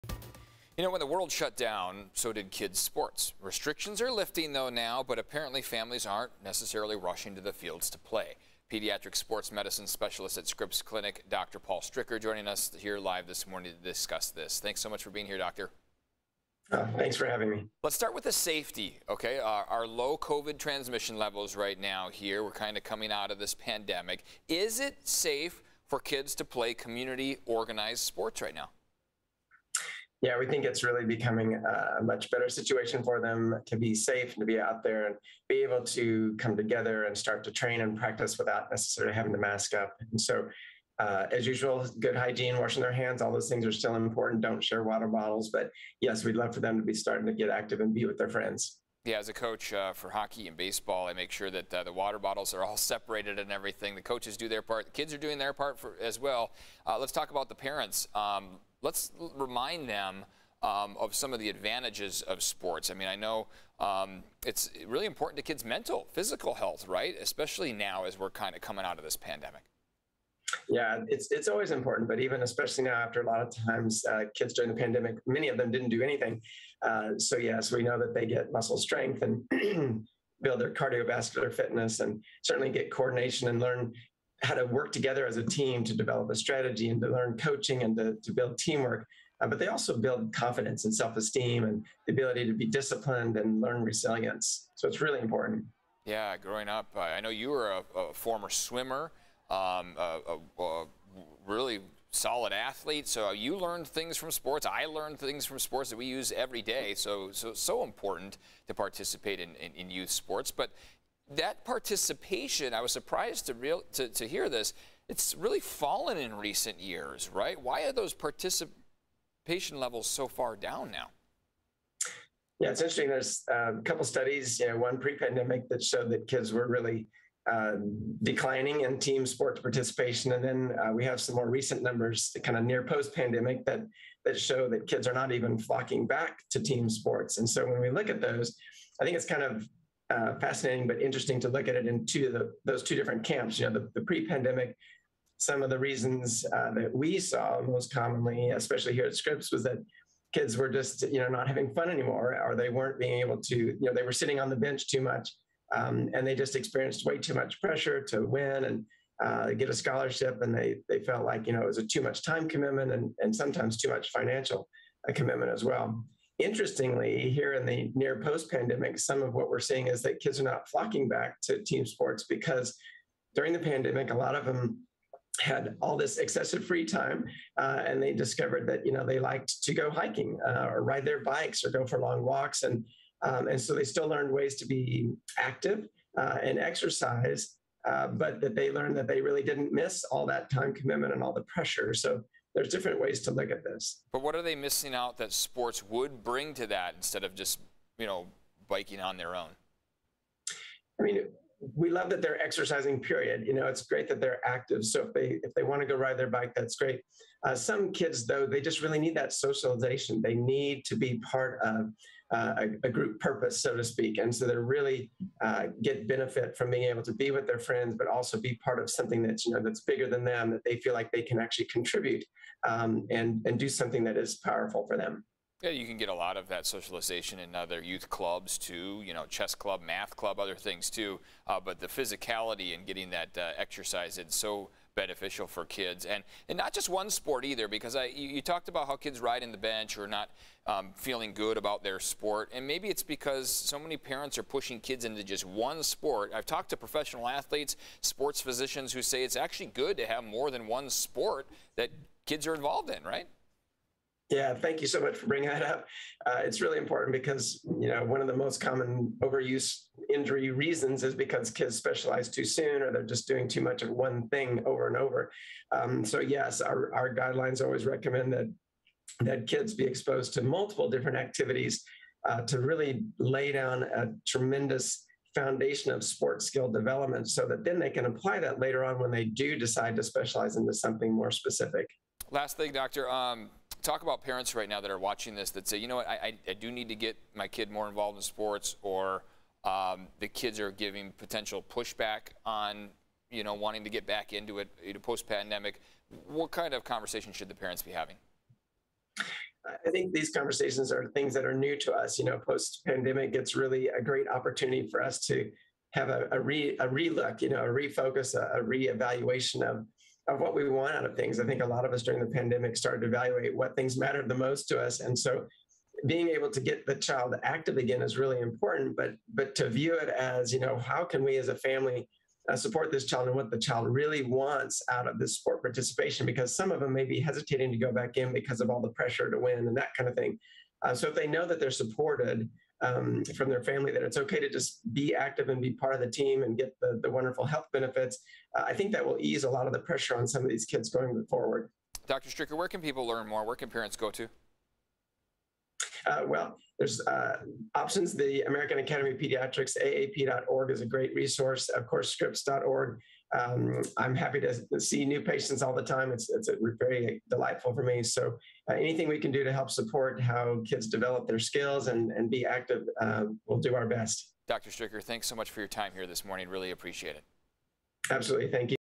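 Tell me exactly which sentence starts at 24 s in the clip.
Is it safe for kids to play community organized sports right now?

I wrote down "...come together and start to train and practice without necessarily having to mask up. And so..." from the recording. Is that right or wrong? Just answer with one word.
right.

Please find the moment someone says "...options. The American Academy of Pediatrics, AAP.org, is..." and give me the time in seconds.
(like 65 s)
347 s.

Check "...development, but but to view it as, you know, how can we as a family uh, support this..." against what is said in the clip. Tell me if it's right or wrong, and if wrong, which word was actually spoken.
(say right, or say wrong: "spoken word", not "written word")
wrong: "important", not "development".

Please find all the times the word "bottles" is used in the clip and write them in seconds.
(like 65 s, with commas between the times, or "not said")
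45 s, 52 s.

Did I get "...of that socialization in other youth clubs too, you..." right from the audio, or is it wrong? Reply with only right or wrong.
right.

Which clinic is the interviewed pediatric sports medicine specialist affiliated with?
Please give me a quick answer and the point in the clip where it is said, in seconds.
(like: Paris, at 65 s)
Scripps Clinic, at 10 s.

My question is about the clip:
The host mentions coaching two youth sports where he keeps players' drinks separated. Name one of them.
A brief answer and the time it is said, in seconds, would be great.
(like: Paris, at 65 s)
hockey, at 50 s.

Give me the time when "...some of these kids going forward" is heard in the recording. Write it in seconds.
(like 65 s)
340 s.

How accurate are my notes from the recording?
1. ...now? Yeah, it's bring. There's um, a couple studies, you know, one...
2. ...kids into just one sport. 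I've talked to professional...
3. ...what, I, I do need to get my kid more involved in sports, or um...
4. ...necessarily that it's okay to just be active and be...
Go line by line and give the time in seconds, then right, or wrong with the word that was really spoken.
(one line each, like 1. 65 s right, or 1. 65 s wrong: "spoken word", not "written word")
1. 120 s wrong: "interesting", not "bring"
2. 244 s right
3. 285 s right
4. 333 s wrong: "family", not "necessarily".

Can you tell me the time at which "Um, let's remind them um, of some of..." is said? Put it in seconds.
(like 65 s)
58 s.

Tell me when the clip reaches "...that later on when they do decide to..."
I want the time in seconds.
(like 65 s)
278 s.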